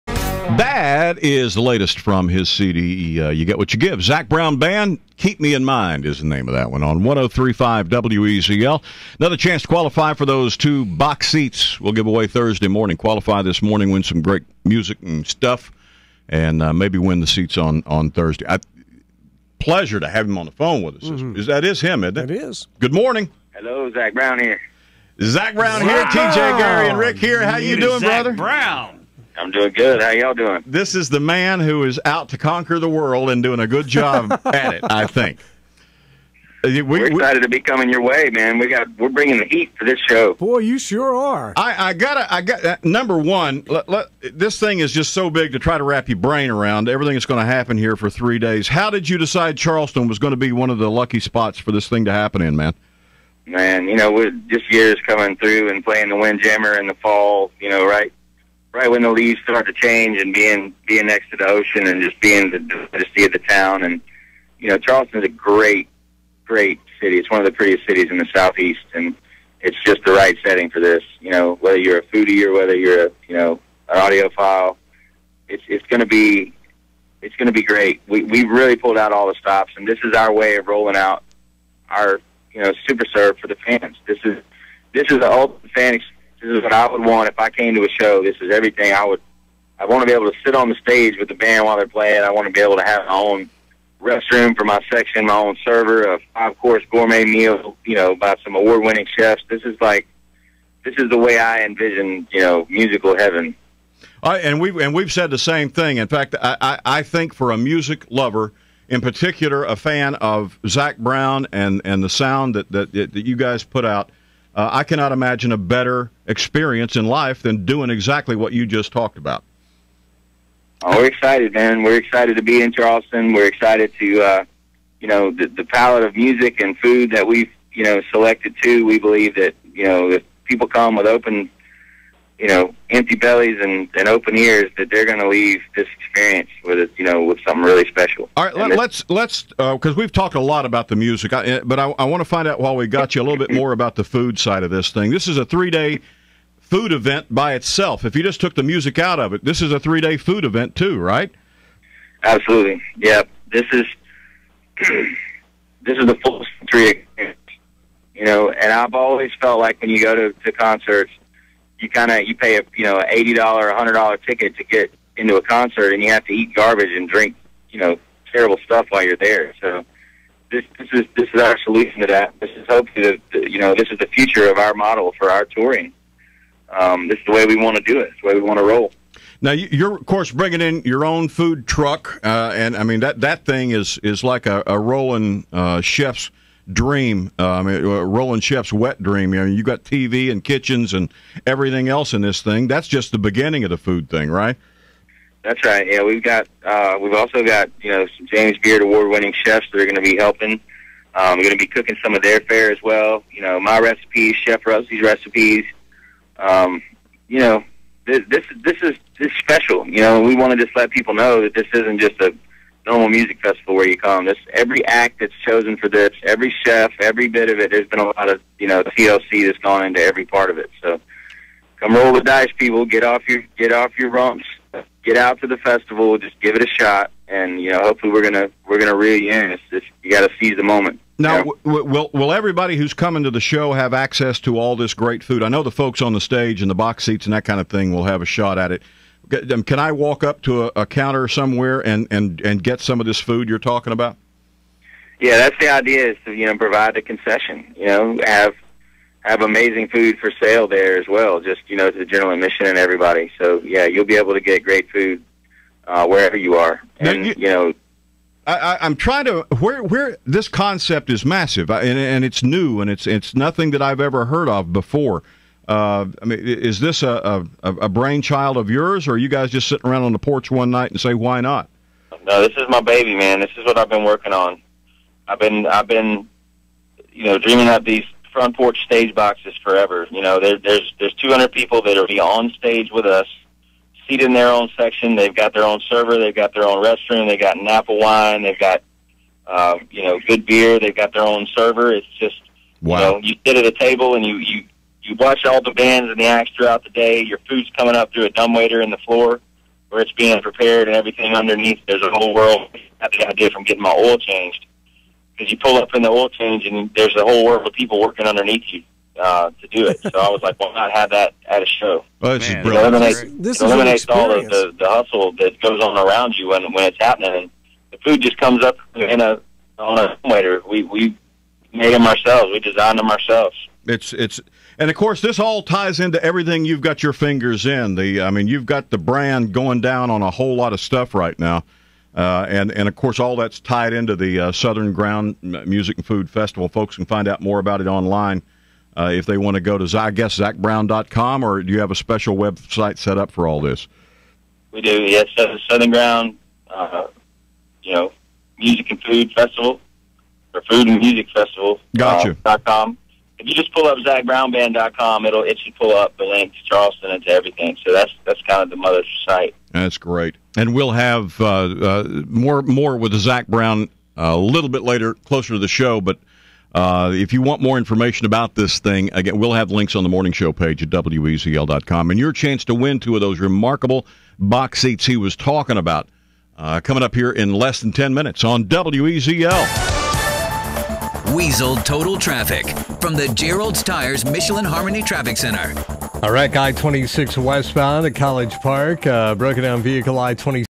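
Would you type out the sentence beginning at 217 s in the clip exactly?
There's been a lot of you know TLC that's gone into every part of it.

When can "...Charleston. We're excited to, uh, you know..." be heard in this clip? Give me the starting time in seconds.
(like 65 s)
122 s.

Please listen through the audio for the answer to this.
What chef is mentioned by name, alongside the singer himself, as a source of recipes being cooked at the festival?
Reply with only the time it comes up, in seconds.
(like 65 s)
204 s.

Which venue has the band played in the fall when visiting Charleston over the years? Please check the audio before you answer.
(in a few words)
The Windjammer.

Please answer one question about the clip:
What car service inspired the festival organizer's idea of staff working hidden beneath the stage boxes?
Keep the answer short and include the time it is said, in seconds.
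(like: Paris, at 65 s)
Getting my oil changed, at 303 s.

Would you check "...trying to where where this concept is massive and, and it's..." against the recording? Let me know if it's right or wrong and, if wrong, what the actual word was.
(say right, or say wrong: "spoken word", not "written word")
right.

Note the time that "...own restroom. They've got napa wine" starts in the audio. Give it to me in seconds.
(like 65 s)
286 s.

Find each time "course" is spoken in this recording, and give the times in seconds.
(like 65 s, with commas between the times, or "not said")
96 s, 180 s, 324 s, 332 s.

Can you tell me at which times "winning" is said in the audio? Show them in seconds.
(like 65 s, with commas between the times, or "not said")
98 s, 199 s.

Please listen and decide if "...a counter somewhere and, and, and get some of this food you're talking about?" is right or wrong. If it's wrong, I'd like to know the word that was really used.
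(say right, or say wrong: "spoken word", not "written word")
right.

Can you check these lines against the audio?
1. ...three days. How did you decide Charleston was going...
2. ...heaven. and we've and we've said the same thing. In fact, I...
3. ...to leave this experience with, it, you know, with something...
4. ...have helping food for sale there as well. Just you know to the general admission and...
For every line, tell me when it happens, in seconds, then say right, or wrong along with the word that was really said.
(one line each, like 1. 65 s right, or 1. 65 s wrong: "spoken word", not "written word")
1. 48 s right
2. 103 s right
3. 135 s right
4. 249 s wrong: "amazing", not "helping".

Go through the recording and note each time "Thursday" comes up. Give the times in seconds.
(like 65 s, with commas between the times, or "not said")
12 s, 18 s.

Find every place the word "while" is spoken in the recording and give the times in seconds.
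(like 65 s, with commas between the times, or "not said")
91 s, 142 s, 168 s.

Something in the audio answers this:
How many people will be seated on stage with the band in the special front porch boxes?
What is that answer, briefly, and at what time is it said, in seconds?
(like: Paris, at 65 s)
200, at 281 s.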